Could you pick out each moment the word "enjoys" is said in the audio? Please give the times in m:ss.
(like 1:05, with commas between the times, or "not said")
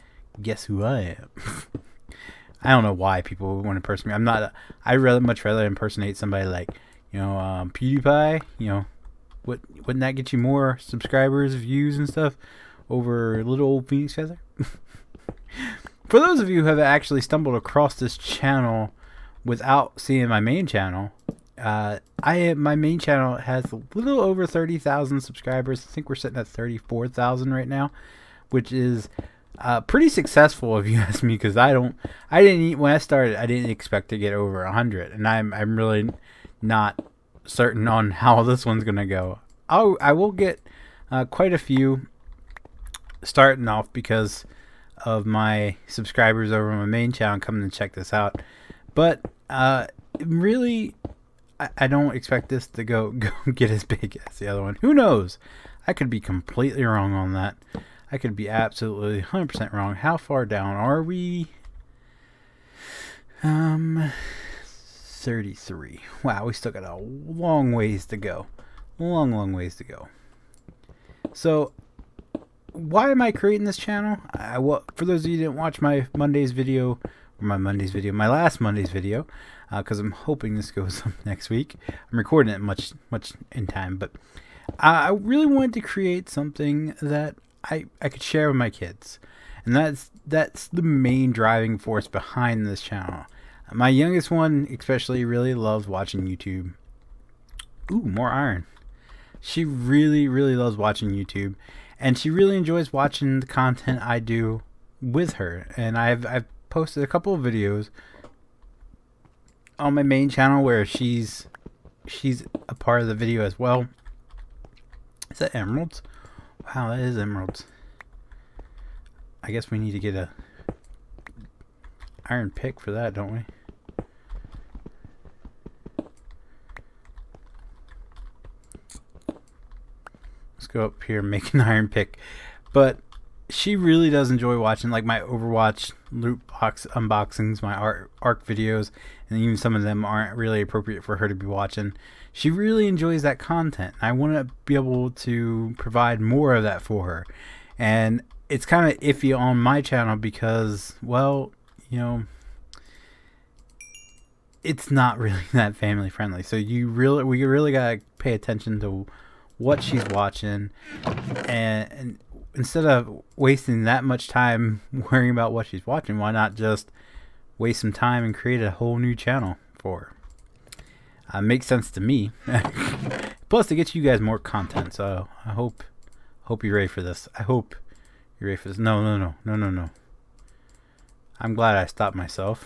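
1:42, 2:14, 2:22.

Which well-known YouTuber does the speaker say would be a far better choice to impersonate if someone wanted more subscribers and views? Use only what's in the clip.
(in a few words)
PewDiePie.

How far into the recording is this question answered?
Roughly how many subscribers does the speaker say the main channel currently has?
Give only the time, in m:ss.
0:26.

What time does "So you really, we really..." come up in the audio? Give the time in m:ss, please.
2:36.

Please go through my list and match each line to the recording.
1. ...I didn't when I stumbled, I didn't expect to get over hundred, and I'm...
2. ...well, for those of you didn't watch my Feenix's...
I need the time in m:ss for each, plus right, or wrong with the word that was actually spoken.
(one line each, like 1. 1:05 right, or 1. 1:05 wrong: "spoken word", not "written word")
1. 0:32 wrong: "started", not "stumbled"
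2. 1:14 wrong: "Monday", not "Feenix".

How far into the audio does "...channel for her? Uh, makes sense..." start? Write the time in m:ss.
2:49.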